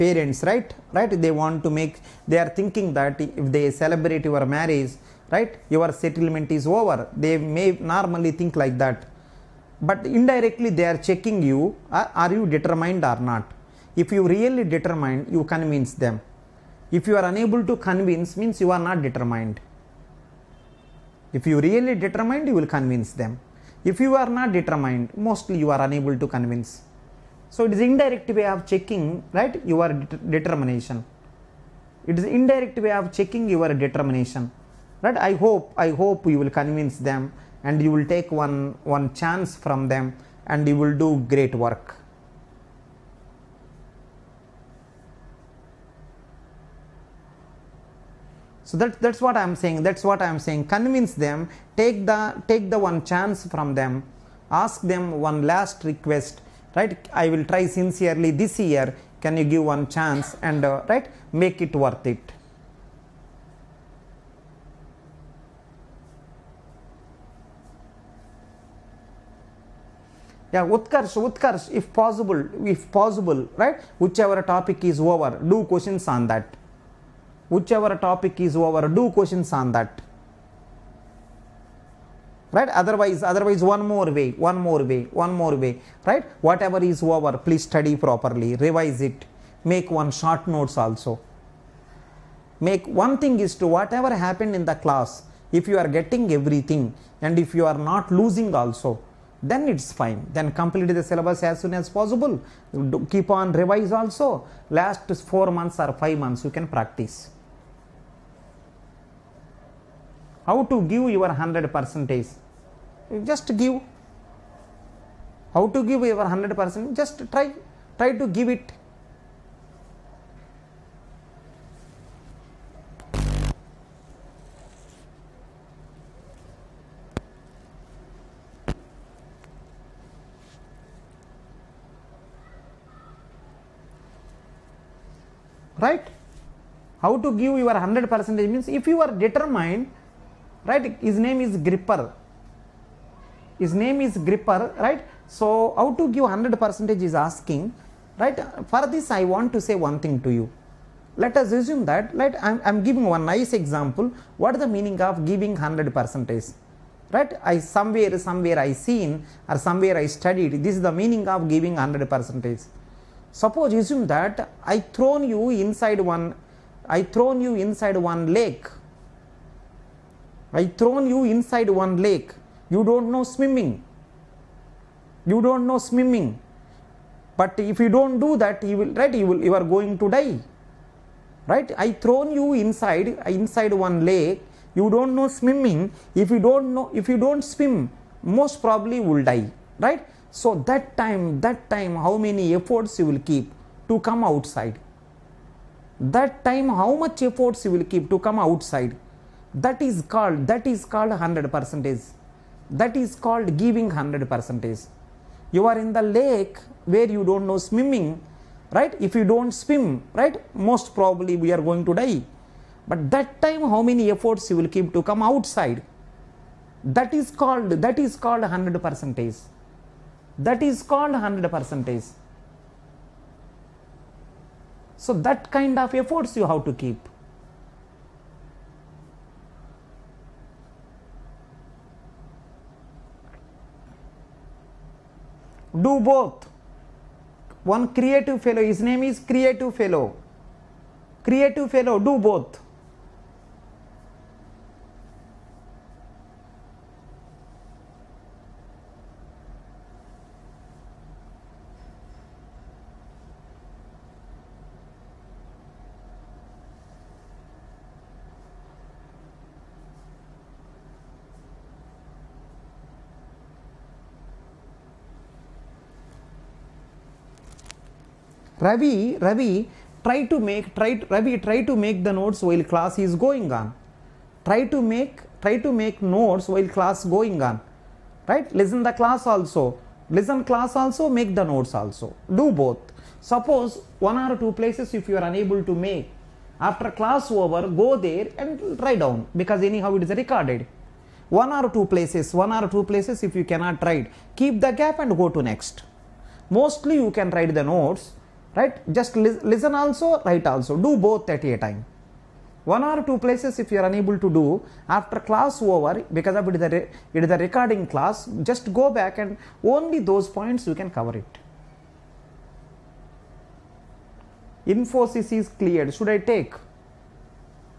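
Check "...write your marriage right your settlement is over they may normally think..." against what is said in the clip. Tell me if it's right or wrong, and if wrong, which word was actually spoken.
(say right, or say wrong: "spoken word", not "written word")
wrong: "celebrate", not "write".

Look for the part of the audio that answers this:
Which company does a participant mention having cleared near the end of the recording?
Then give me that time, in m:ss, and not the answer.
5:14.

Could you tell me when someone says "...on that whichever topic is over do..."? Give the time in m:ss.
1:16.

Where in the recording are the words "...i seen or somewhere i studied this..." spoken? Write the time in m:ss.
2:38.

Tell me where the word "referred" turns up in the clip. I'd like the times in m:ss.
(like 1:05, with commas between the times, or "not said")
not said.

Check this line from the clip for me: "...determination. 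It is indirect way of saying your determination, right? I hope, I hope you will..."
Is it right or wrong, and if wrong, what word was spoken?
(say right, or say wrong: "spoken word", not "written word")
wrong: "checking", not "saying".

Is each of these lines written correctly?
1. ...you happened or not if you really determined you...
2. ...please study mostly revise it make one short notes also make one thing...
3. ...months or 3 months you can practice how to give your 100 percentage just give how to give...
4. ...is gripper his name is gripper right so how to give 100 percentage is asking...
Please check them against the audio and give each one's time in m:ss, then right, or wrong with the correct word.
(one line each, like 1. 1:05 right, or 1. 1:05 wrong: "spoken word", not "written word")
1. 0:12 wrong: "determined", not "happened"
2. 1:27 wrong: "properly", not "mostly"
3. 1:45 wrong: "5", not "3"
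4. 2:21 right.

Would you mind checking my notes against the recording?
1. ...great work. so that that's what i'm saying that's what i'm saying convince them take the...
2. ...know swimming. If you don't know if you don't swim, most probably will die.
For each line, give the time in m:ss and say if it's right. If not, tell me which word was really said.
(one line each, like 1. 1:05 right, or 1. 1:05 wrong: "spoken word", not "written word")
1. 0:41 right
2. 3:05 right.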